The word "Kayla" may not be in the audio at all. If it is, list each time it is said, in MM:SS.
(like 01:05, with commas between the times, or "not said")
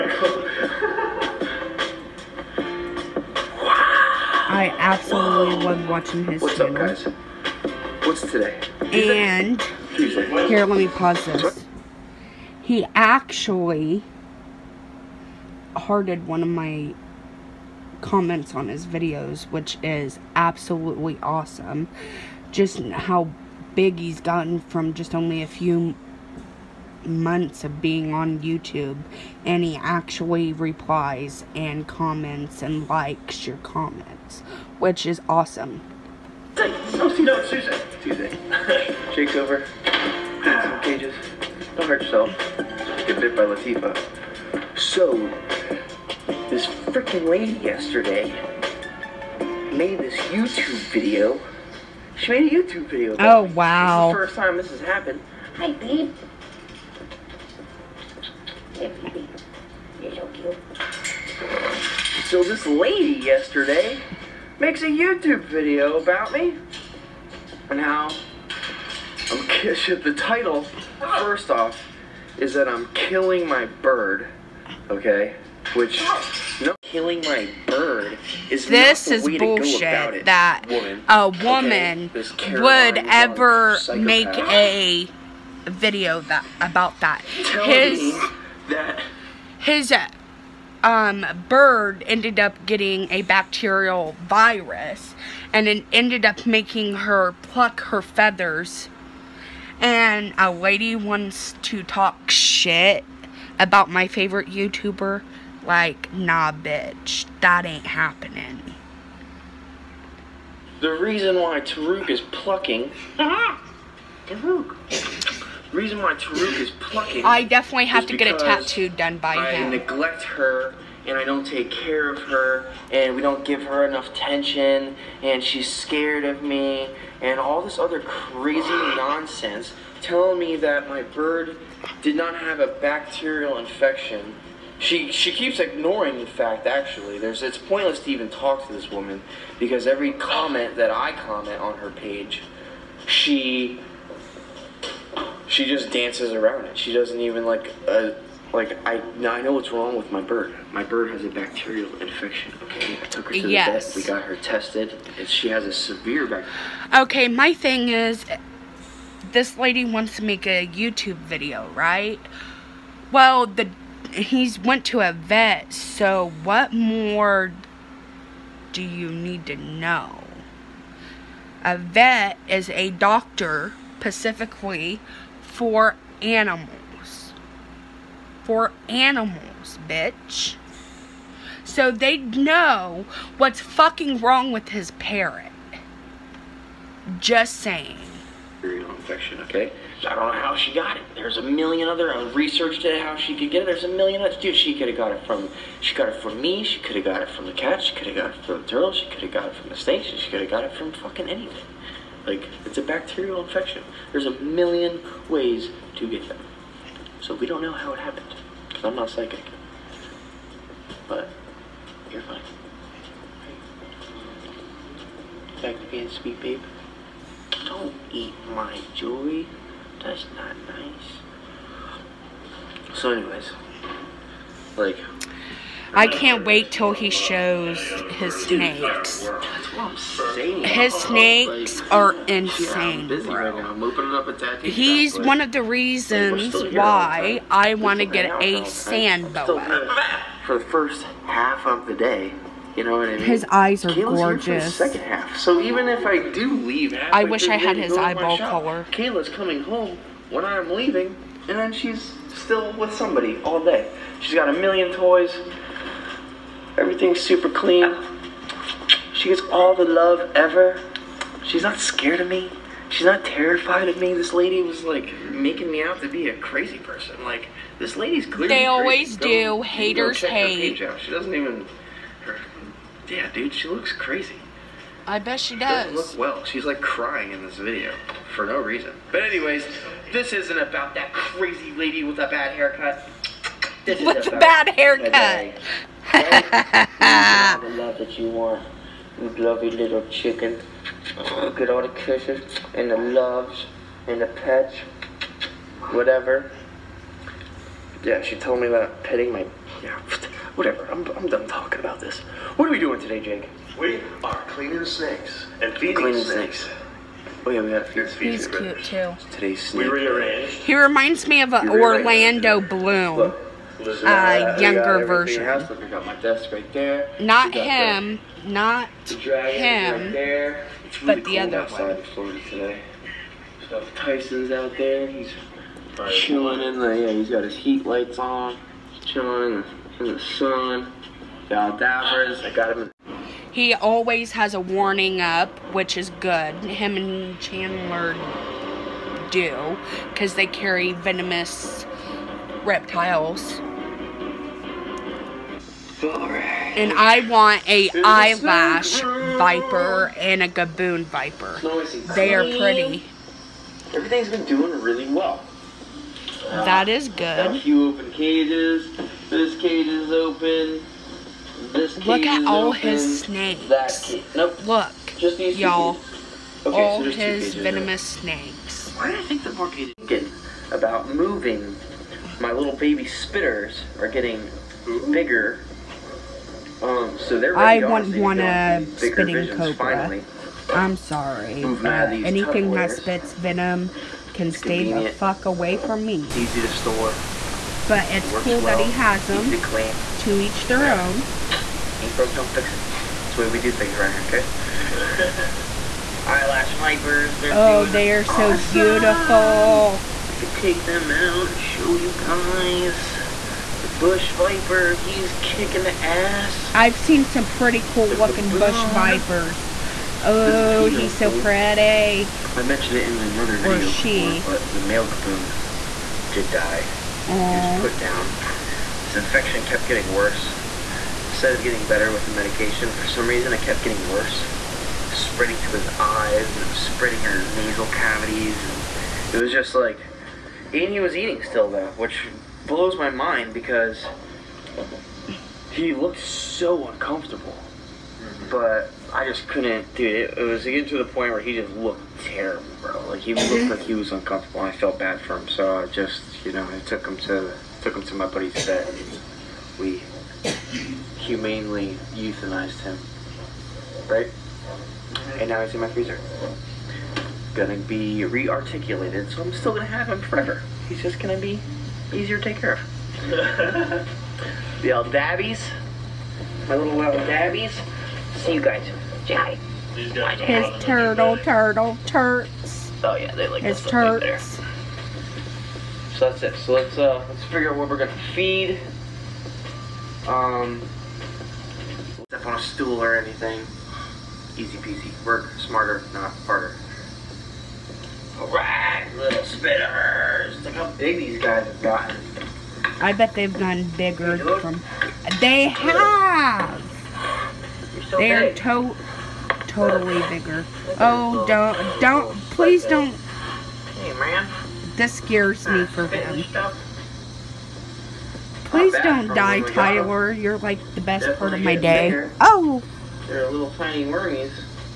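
04:03, 04:08.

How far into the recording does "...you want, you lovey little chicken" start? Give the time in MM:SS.
04:48.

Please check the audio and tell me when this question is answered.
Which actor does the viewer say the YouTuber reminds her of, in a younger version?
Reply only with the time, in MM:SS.
05:11.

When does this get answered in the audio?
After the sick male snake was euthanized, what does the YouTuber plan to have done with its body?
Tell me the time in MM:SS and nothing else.
07:38.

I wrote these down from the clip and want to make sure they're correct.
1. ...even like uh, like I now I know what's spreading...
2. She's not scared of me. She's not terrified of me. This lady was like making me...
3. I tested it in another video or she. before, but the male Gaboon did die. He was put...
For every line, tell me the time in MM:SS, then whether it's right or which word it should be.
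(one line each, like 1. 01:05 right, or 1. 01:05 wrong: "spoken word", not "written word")
1. 02:27 wrong: "wrong", not "spreading"
2. 04:21 right
3. 06:52 wrong: "mentioned", not "tested".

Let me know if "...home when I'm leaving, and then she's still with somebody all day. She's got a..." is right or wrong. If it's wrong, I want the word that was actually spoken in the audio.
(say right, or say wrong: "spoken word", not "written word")
right.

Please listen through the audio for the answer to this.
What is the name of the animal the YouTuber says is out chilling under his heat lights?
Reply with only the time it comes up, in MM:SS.
05:23.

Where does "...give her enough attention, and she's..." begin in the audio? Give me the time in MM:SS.
02:03.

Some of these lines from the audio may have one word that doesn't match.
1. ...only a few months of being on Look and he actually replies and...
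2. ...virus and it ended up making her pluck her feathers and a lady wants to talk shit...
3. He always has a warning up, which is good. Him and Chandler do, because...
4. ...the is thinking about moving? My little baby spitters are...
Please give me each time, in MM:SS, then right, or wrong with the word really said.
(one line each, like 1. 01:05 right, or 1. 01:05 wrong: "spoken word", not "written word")
1. 00:25 wrong: "YouTube", not "Look"
2. 01:34 right
3. 05:33 right
4. 06:09 right.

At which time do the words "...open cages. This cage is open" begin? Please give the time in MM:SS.
05:57.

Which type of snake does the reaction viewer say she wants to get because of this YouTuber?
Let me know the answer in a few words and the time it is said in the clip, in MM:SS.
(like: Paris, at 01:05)
Sand boa, at 03:58.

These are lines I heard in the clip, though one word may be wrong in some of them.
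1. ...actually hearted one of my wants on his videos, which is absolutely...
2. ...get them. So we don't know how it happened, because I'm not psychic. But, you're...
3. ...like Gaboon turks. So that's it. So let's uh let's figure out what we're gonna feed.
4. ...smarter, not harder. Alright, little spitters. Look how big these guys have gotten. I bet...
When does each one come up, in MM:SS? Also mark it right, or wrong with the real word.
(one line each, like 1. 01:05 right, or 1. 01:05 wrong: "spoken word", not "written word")
1. 00:12 wrong: "comments", not "wants"
2. 03:26 right
3. 07:53 wrong: "His", not "Gaboon"
4. 08:05 right.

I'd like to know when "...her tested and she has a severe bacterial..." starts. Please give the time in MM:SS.
02:34.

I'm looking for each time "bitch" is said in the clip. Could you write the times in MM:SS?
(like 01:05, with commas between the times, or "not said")
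01:46, 02:59.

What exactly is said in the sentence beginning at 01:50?
The reason why Taruk is plucking.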